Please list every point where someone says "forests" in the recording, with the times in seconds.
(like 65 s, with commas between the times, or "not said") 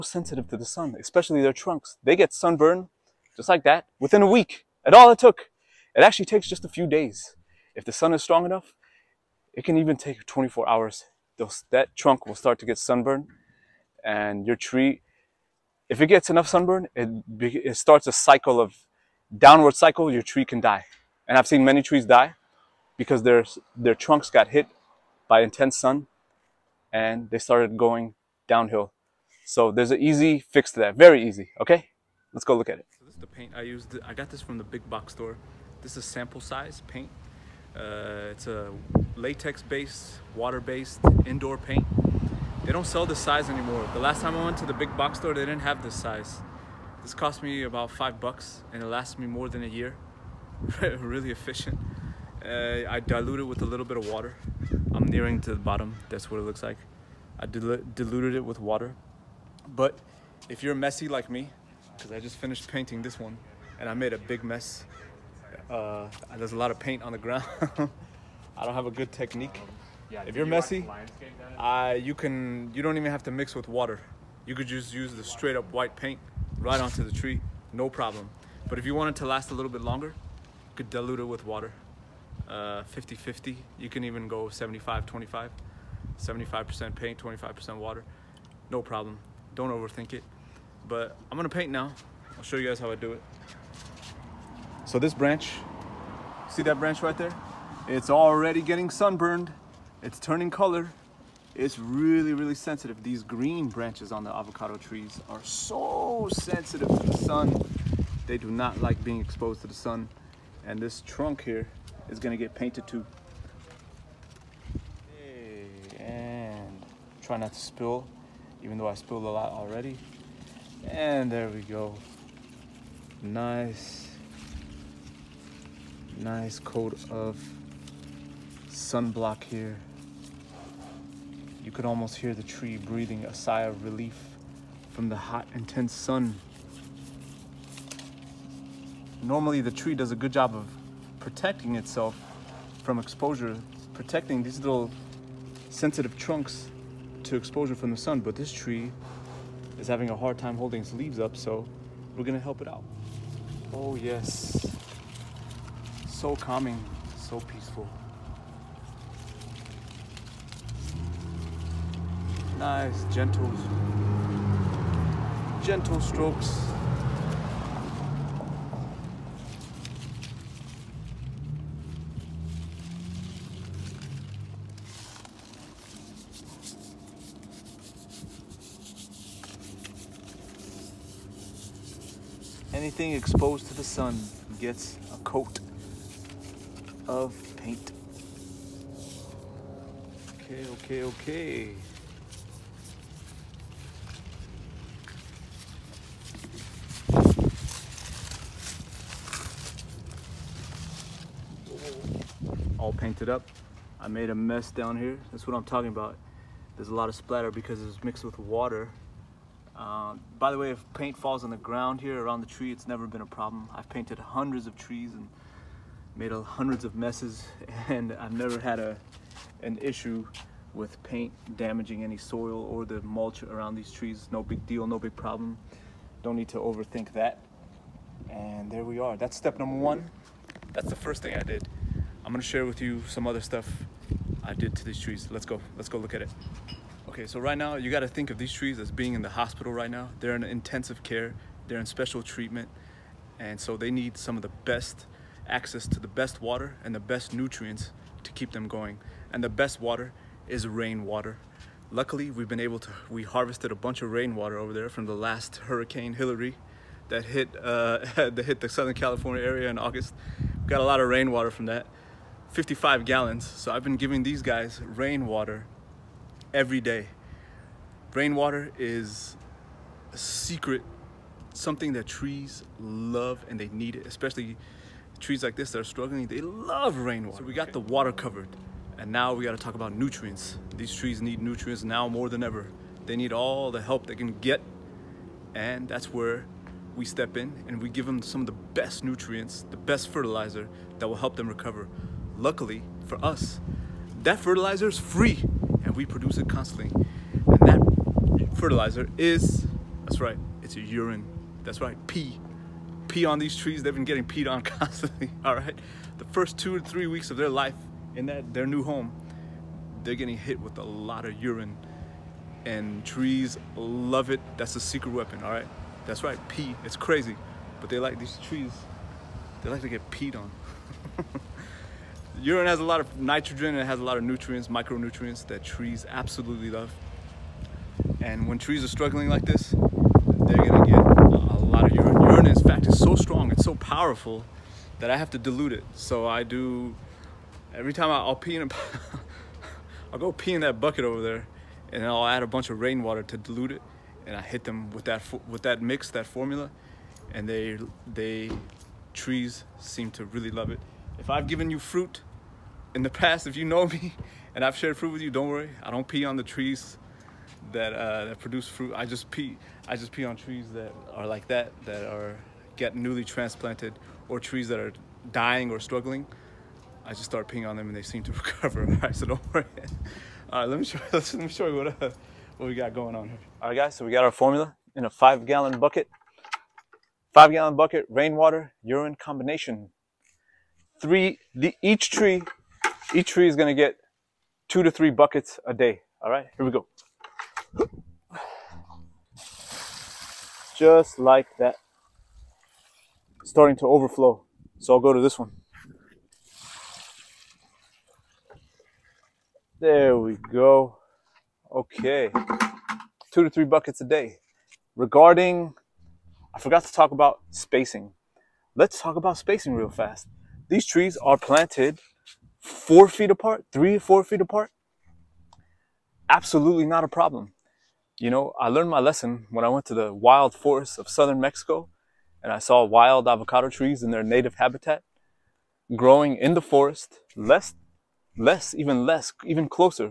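420 s, 426 s.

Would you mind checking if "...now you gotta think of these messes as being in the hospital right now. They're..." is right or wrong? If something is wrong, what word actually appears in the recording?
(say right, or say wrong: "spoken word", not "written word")
wrong: "trees", not "messes".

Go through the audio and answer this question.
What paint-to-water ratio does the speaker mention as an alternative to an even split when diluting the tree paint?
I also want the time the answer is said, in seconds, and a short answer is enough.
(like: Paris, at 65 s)
75-25, at 84 s.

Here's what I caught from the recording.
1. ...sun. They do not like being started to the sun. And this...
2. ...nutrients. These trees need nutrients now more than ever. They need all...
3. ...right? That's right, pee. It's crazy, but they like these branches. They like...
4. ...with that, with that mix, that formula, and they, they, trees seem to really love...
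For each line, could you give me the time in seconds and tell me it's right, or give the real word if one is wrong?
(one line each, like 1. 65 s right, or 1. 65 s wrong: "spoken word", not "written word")
1. 107 s wrong: "exposed", not "started"
2. 279 s right
3. 315 s wrong: "trees", not "branches"
4. 344 s right.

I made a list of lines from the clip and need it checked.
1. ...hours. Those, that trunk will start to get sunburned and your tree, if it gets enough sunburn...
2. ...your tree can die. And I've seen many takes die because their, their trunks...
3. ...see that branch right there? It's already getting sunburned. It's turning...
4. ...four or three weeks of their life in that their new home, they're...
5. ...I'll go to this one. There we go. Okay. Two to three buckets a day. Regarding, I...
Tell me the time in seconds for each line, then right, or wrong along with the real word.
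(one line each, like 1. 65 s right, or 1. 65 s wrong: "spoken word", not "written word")
1. 10 s right
2. 20 s wrong: "trees", not "takes"
3. 96 s right
4. 306 s wrong: "two", not "four"
5. 394 s right.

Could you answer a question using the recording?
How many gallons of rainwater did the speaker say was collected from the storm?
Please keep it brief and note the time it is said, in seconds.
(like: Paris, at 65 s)
55 gallons, at 262 s.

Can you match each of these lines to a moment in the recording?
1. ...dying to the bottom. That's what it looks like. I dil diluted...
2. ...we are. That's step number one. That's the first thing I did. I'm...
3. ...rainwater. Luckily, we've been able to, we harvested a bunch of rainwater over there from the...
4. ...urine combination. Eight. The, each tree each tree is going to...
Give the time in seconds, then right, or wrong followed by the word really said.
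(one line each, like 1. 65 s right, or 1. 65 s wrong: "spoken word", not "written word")
1. 55 s wrong: "nearing", not "dying"
2. 228 s right
3. 250 s right
4. 378 s wrong: "Three", not "Eight".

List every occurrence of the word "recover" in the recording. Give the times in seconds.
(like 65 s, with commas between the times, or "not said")
291 s, 368 s.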